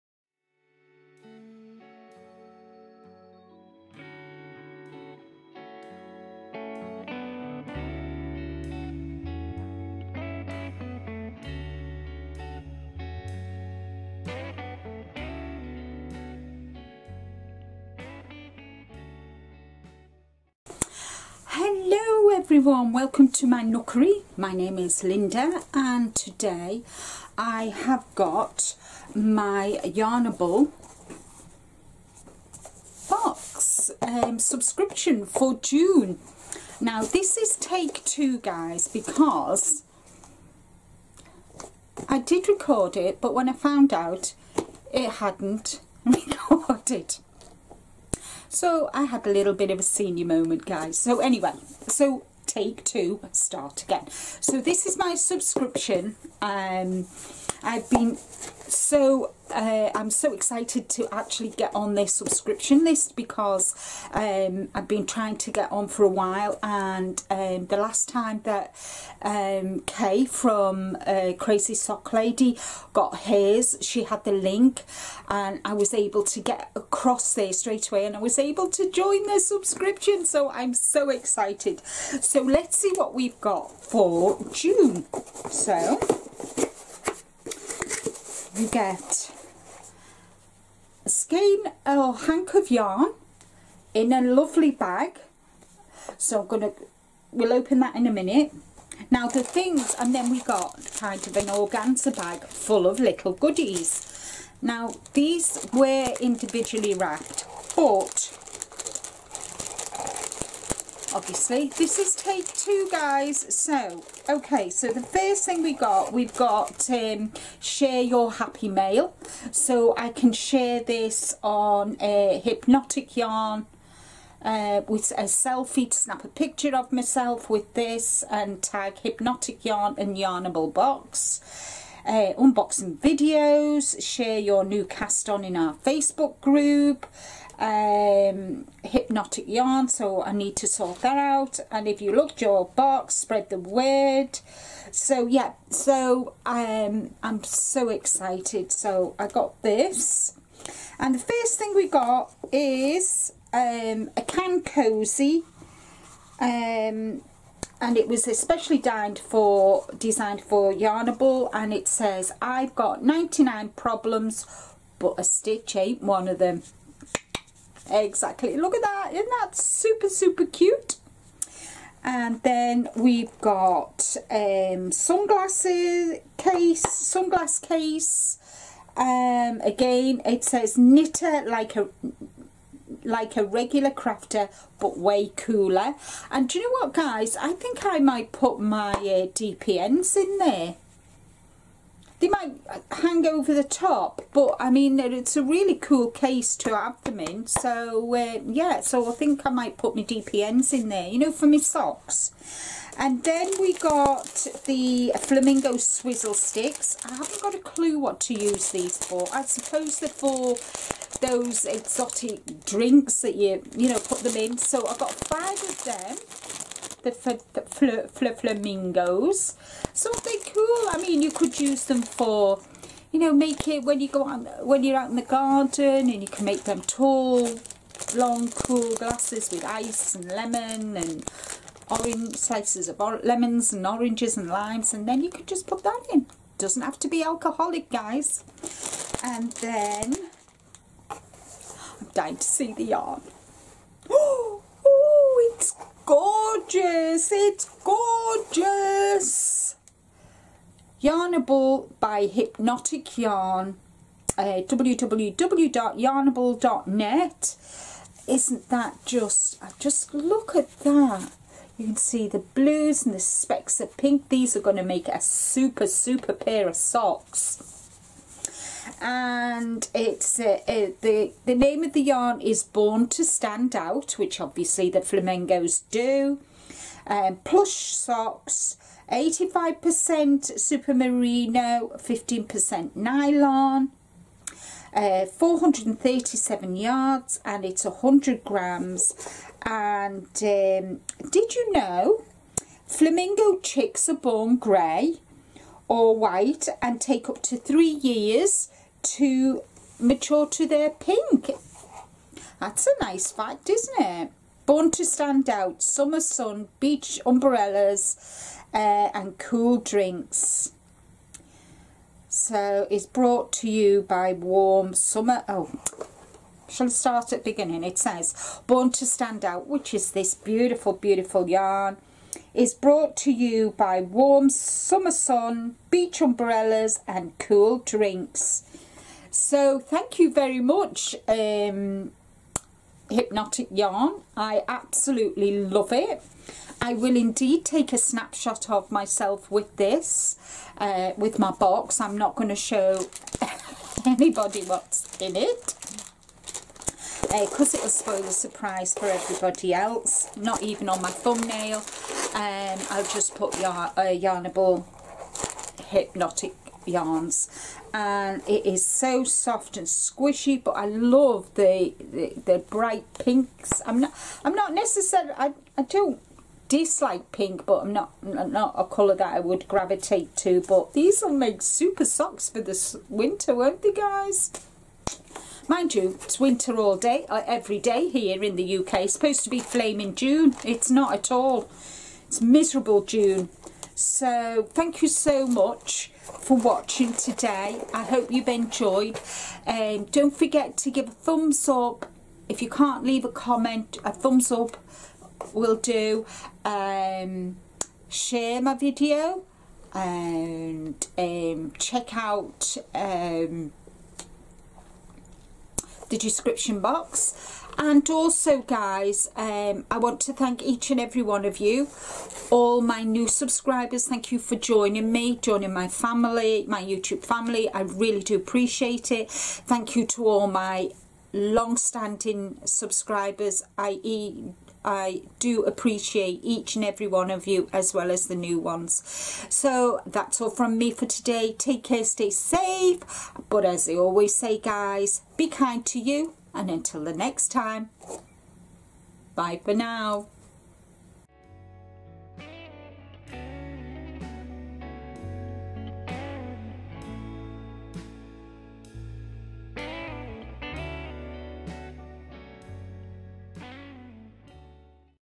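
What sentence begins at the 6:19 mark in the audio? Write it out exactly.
It's supposed to be flaming June.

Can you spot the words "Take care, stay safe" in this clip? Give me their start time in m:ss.
7:11.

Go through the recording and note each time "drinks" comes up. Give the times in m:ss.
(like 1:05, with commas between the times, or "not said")
3:32, 5:09, 5:27.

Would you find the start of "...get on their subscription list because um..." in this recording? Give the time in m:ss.
1:01.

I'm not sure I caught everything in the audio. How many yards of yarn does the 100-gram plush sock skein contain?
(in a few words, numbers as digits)
437.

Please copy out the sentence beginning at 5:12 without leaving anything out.
So it's brought to you by Warm Summer.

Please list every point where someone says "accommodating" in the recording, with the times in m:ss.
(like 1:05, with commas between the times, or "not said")
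not said.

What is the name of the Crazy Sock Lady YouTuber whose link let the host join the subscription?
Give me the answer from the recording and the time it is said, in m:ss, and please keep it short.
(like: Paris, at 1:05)
Kay, at 1:09.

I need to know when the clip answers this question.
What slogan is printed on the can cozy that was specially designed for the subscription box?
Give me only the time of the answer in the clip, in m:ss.
2:43.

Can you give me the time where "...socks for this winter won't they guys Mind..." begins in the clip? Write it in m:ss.
6:12.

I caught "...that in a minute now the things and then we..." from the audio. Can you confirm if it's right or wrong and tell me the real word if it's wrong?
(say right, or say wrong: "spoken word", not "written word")
right.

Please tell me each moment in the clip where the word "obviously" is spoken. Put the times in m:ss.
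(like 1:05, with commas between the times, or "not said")
1:51, 4:34.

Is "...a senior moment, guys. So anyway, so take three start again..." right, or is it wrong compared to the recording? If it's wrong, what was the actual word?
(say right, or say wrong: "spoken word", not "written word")
wrong: "two", not "three".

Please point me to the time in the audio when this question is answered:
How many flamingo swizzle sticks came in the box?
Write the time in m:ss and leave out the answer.
3:35.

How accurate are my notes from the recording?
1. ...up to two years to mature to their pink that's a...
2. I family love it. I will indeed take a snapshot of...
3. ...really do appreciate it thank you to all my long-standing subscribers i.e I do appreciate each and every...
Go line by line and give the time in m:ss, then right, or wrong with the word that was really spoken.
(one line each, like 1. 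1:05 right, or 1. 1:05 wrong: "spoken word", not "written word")
1. 4:57 wrong: "three", not "two"
2. 5:34 wrong: "absolutely", not "family"
3. 6:57 right.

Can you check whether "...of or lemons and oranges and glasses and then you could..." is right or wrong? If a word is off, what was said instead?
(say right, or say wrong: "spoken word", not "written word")
wrong: "limes", not "glasses".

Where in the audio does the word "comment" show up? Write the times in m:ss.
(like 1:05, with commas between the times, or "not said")
6:33.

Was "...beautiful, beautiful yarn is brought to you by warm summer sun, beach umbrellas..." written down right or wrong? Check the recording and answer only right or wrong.
right.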